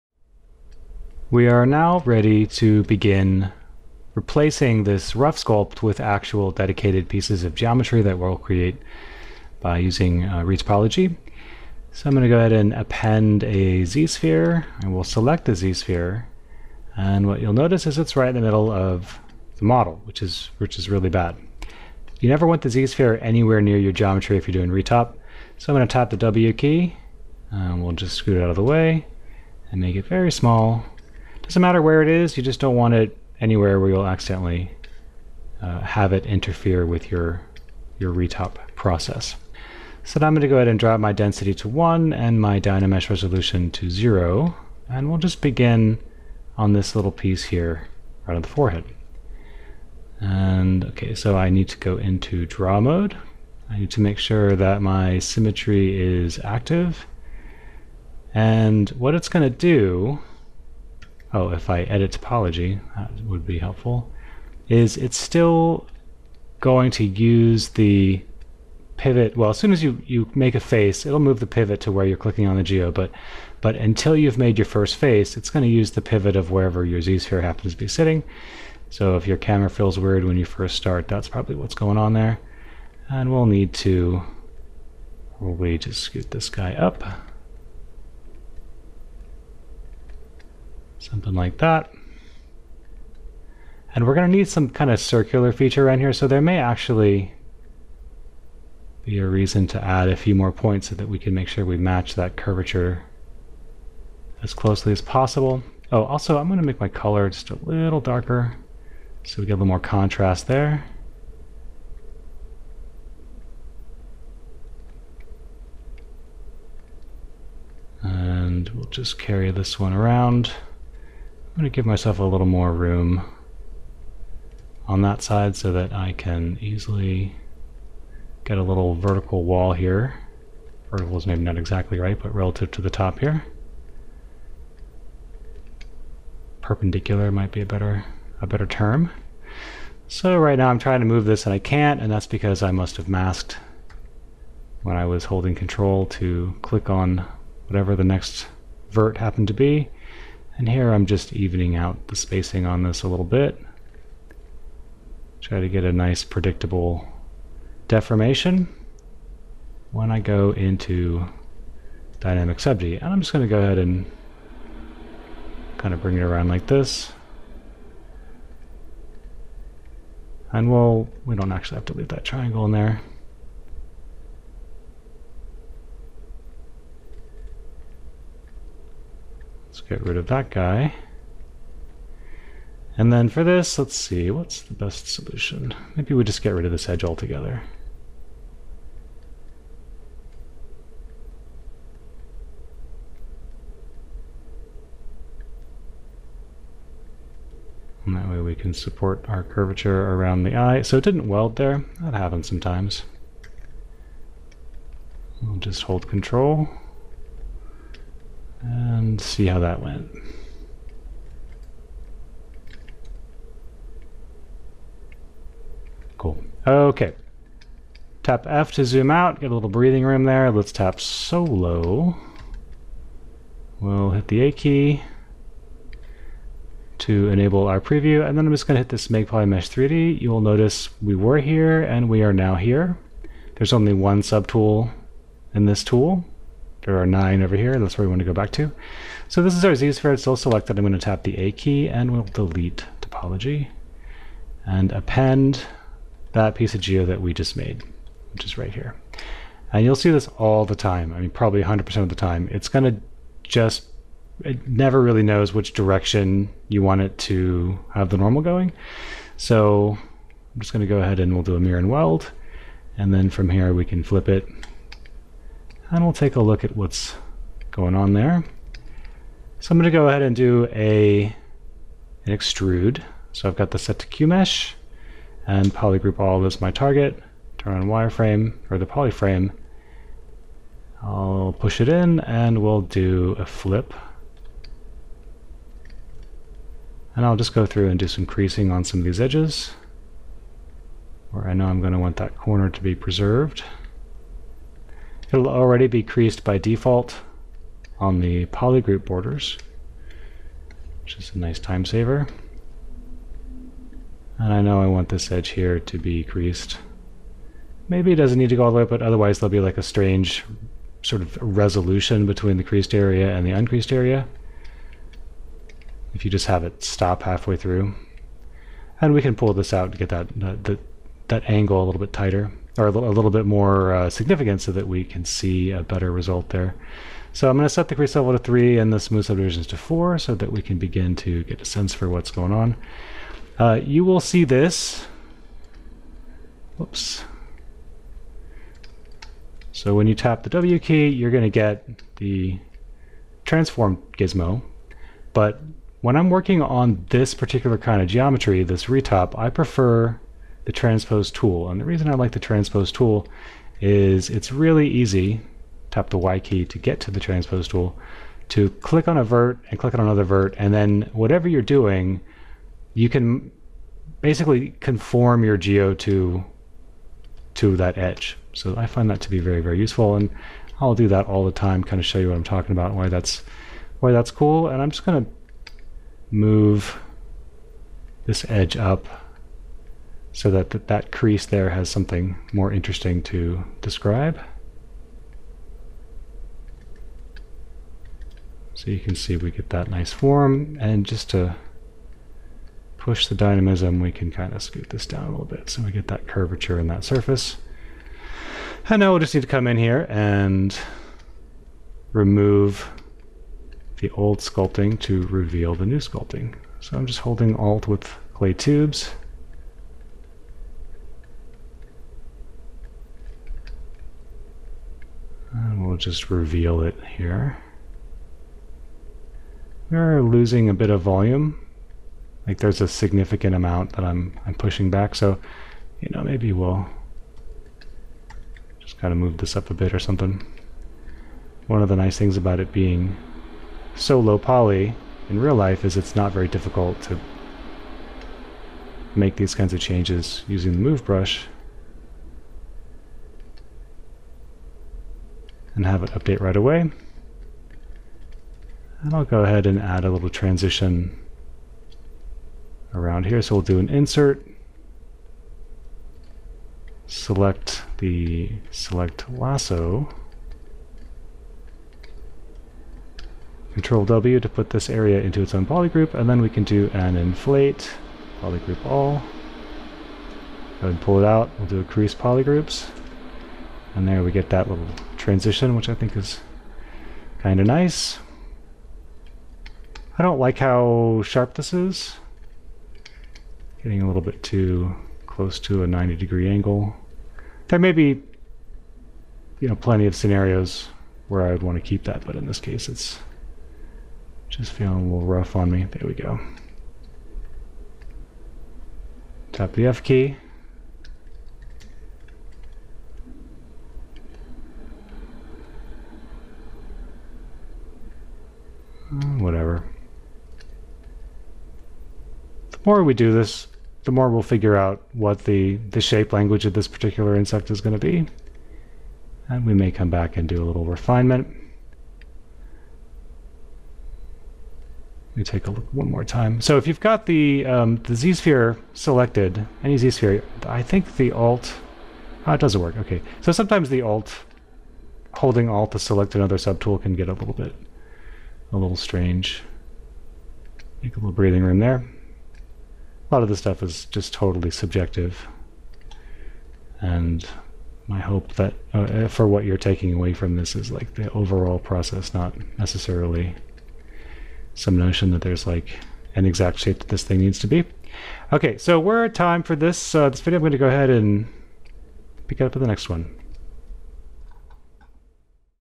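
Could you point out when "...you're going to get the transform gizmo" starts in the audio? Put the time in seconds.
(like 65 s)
341 s.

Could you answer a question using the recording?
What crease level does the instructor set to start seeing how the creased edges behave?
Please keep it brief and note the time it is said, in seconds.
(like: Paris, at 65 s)
3, at 328 s.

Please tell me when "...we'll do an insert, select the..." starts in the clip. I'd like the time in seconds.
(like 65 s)
453 s.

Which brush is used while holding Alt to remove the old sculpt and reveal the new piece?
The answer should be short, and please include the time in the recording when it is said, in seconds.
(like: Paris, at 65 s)
clay tubes, at 408 s.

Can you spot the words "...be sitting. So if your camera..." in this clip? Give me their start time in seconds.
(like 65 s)
77 s.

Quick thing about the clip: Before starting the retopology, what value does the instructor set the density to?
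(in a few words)
1.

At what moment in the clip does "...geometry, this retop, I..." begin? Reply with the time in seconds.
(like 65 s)
348 s.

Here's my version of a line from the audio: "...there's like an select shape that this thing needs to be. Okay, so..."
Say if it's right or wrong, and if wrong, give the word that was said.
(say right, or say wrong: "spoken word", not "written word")
wrong: "exact", not "select".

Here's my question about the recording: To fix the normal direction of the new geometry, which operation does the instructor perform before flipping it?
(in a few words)
mirror and weld.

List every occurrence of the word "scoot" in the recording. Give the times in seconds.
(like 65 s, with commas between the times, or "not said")
28 s, 86 s, 394 s.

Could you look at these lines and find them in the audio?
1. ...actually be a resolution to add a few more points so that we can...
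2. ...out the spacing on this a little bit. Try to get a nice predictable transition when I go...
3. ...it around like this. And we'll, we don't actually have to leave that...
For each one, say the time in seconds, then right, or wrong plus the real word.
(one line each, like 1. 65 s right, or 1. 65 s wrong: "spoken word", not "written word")
1. 96 s wrong: "reason", not "resolution"
2. 151 s wrong: "deformation", not "transition"
3. 166 s right.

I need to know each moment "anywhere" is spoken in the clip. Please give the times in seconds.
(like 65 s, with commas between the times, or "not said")
23 s, 33 s.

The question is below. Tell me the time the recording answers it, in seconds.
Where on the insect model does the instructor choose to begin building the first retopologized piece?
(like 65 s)
48 s.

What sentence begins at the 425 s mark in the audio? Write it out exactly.
So, you know, maybe we'll just kind of move this up a bit or something.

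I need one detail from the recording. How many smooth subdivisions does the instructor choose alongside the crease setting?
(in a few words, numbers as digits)
4.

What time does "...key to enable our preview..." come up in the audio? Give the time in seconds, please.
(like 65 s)
224 s.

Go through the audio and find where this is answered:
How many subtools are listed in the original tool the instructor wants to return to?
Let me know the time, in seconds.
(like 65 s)
237 s.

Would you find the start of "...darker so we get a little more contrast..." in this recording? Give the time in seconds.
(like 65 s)
107 s.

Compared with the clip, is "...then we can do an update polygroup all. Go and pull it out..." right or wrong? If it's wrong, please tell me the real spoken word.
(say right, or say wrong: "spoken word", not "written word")
wrong: "inflate", not "update".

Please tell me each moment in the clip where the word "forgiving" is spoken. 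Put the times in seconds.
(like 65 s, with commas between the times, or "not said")
not said.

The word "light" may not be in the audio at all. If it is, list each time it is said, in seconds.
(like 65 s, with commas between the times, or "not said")
not said.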